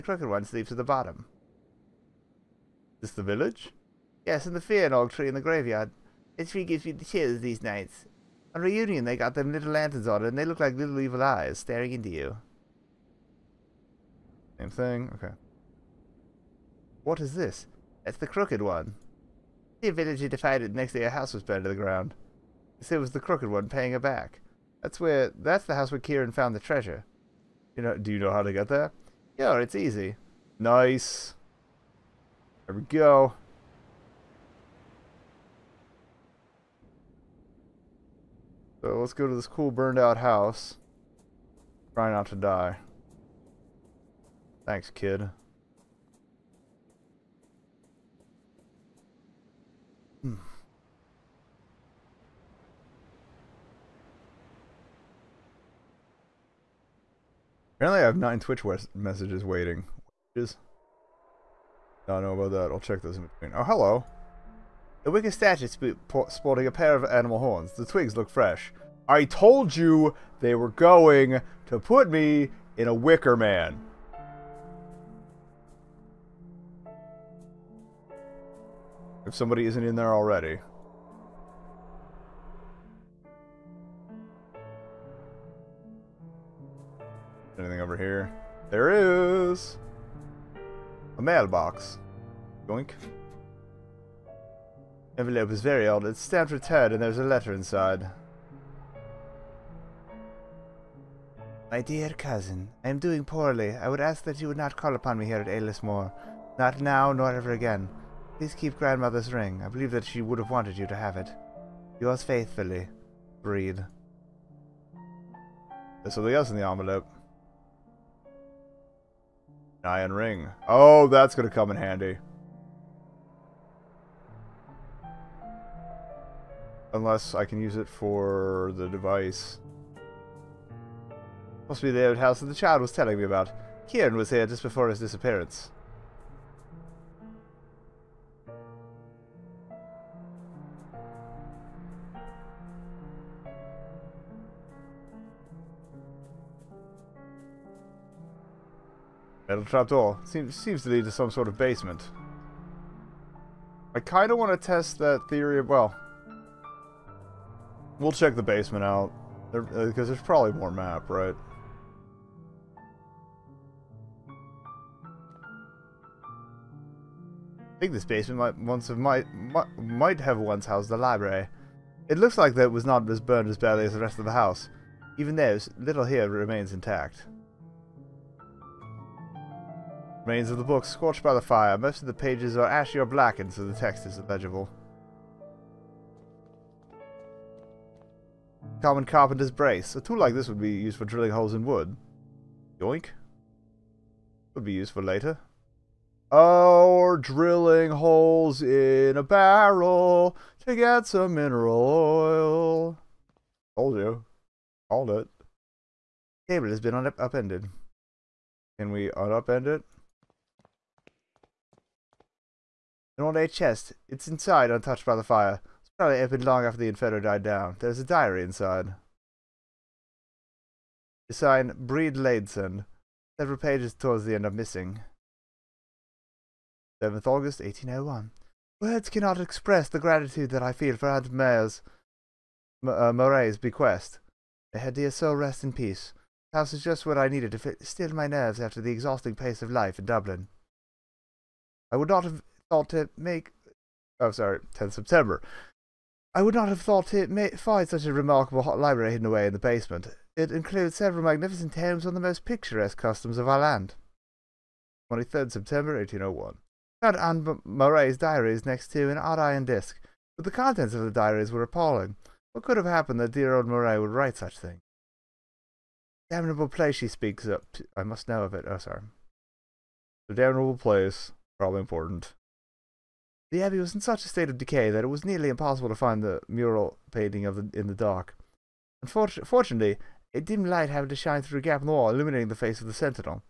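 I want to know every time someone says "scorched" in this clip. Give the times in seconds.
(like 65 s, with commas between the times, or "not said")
180 s.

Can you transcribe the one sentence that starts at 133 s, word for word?
Kieran was here just before his disappearance.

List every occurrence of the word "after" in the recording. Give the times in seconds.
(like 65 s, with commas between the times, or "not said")
216 s, 238 s.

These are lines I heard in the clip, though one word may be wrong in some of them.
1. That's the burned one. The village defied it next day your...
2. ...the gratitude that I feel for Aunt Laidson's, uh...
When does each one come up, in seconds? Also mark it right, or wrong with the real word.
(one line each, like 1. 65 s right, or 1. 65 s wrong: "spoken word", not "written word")
1. 18 s wrong: "crooked", not "burned"
2. 229 s wrong: "Mayer", not "Laidson".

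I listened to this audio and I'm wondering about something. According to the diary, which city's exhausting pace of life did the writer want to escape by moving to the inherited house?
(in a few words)
Dublin.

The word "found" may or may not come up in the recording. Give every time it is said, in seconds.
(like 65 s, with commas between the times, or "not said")
26 s, 257 s.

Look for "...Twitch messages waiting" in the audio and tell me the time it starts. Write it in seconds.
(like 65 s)
58 s.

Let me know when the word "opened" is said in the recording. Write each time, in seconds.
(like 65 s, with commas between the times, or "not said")
216 s.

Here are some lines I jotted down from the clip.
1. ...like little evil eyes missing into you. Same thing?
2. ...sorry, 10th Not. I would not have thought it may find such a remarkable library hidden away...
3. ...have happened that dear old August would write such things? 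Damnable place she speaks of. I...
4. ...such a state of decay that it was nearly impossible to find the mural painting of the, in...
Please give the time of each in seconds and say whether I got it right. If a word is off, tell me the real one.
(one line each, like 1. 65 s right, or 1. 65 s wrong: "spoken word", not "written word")
1. 10 s wrong: "staring", not "missing"
2. 244 s wrong: "September", not "Not"
3. 262 s wrong: "Murray", not "August"
4. 273 s right.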